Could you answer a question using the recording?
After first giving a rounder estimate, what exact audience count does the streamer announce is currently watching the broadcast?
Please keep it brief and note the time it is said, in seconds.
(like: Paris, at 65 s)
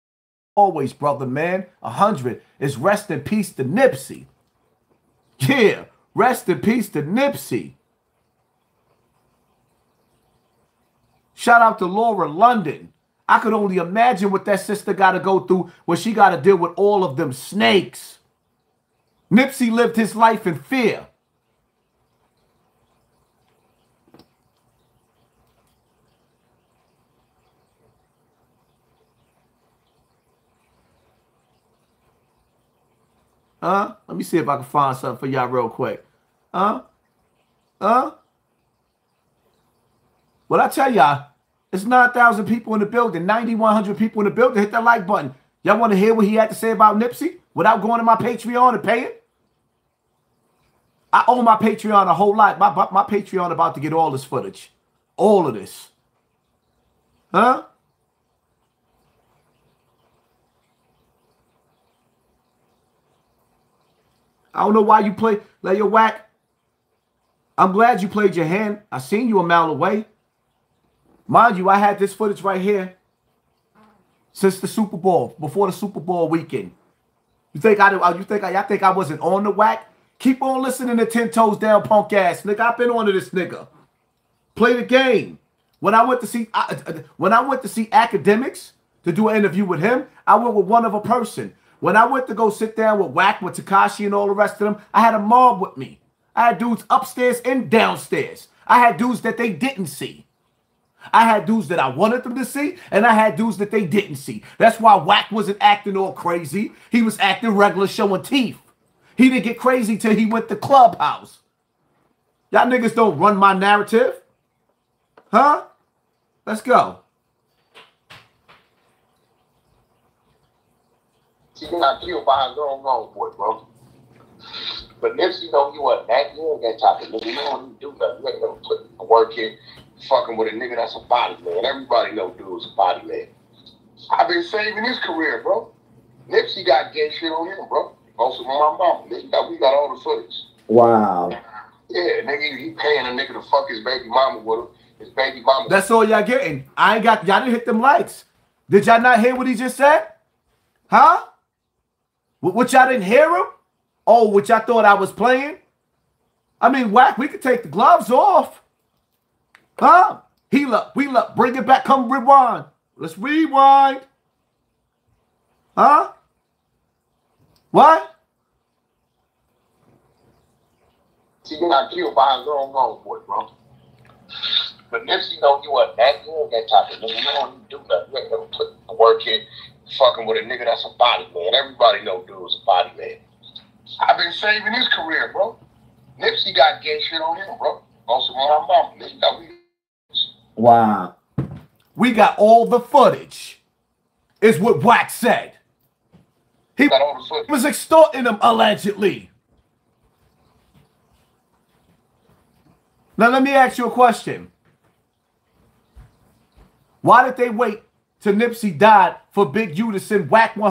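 9,100, at 43 s.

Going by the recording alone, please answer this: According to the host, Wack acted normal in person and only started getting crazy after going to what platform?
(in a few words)
Clubhouse.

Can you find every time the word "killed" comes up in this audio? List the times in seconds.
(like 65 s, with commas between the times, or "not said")
122 s, 171 s.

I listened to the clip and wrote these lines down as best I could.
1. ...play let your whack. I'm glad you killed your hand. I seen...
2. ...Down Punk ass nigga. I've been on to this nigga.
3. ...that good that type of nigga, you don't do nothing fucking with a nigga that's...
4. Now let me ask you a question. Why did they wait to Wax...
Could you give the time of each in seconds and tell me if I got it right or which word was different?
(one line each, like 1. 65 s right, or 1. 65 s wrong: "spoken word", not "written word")
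1. 65 s wrong: "played", not "killed"
2. 81 s right
3. 175 s right
4. 203 s wrong: "Nipsey", not "Wax".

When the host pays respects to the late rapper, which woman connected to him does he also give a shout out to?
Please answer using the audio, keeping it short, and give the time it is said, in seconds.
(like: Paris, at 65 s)
Lauren London, at 11 s.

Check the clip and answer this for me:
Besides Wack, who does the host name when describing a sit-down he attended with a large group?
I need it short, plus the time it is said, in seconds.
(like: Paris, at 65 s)
Tekashi, at 93 s.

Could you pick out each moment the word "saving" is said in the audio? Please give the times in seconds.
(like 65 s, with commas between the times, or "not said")
134 s, 184 s.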